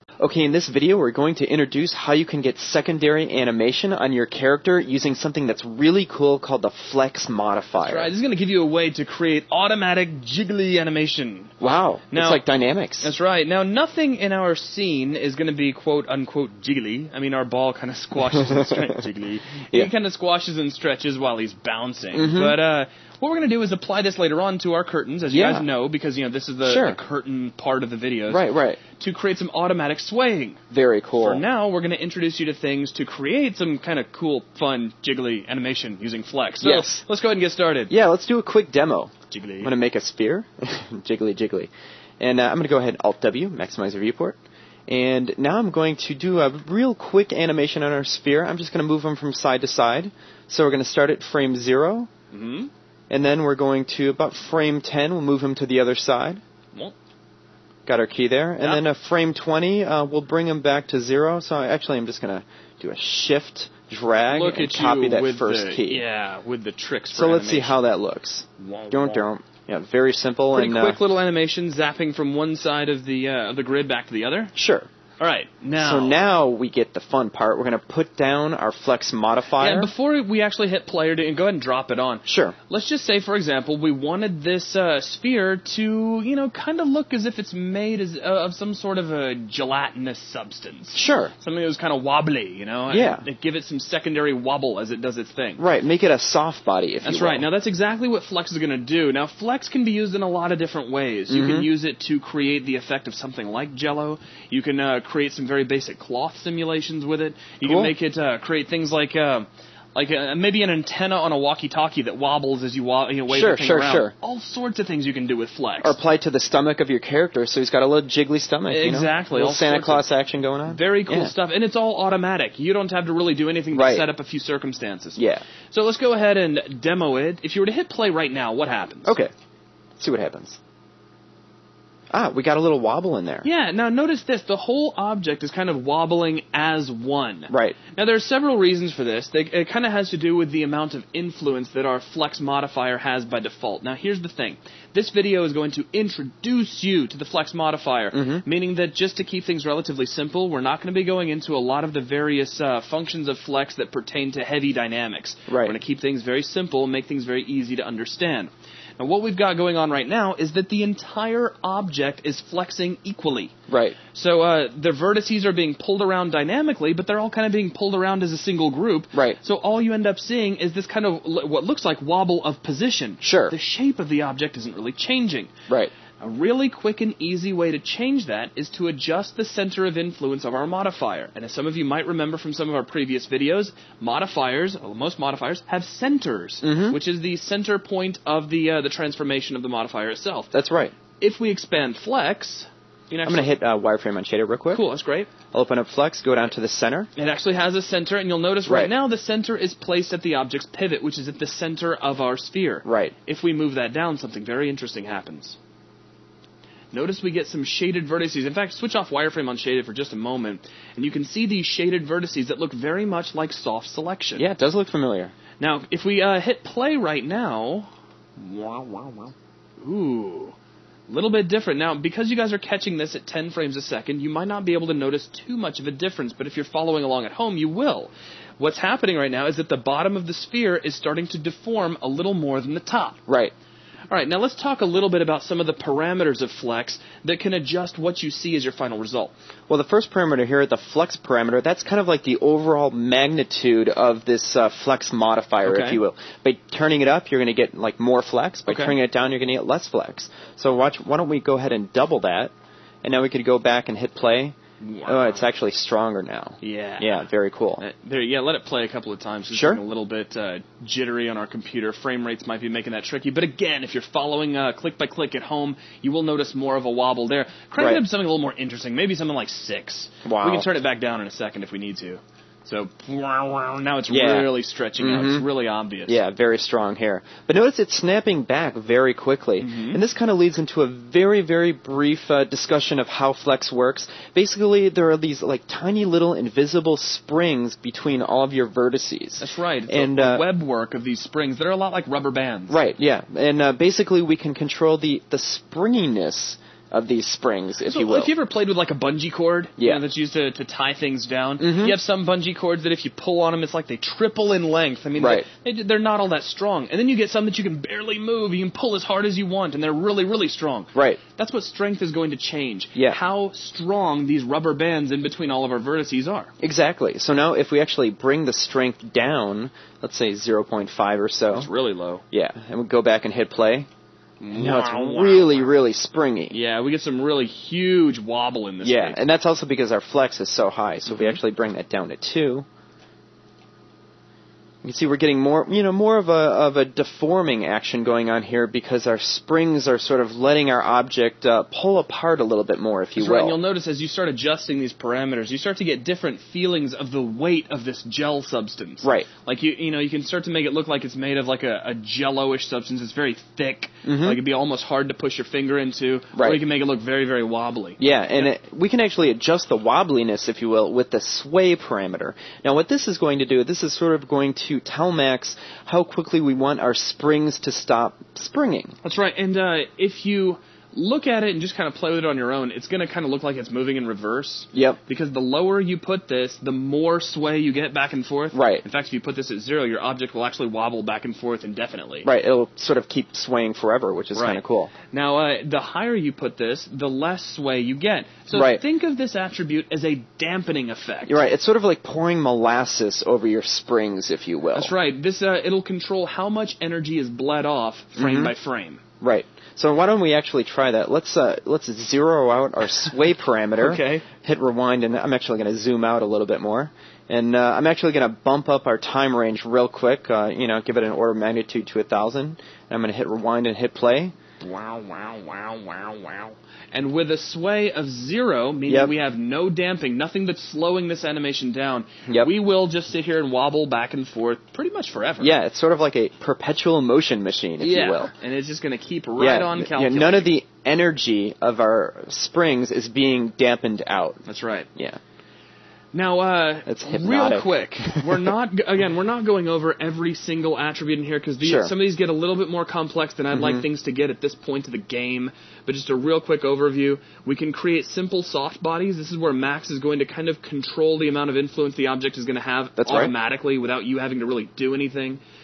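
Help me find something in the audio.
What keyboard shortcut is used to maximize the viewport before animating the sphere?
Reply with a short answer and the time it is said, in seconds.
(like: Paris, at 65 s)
Alt W, at 43 s.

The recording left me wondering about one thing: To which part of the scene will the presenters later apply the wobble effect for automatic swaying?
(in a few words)
curtains.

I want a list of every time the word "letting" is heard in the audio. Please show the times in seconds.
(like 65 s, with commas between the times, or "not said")
340 s.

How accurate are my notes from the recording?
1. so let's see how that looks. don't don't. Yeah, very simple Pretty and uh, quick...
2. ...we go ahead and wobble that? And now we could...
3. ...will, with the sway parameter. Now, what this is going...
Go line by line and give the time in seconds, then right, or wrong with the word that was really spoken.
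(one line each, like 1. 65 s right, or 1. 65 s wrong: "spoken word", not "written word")
1. 67 s right
2. 251 s wrong: "double", not "wobble"
3. 360 s right.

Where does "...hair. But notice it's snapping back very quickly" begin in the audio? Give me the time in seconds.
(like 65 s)
276 s.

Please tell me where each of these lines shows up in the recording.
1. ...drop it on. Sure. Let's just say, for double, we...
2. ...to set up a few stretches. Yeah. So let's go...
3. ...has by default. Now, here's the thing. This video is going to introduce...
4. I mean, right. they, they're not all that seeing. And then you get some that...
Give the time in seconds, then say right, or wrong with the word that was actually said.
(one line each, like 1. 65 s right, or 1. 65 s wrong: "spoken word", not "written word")
1. 81 s wrong: "example", not "double"
2. 123 s wrong: "circumstances", not "stretches"
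3. 142 s right
4. 305 s wrong: "strong", not "seeing".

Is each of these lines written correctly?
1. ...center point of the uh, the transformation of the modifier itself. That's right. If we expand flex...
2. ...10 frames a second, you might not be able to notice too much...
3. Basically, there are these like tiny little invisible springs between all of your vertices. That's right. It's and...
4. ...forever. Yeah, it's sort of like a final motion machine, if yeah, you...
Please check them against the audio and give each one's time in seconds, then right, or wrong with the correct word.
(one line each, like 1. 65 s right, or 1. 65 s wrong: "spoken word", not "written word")
1. 187 s right
2. 223 s right
3. 284 s right
4. 425 s wrong: "perpetual", not "final".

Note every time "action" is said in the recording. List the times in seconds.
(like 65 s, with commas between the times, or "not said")
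120 s, 337 s.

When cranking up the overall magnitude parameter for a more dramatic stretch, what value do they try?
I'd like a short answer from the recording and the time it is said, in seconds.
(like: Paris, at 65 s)
6, at 269 s.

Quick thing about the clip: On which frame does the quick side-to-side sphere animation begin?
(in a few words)
0.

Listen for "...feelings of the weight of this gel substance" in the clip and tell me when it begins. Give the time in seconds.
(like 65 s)
346 s.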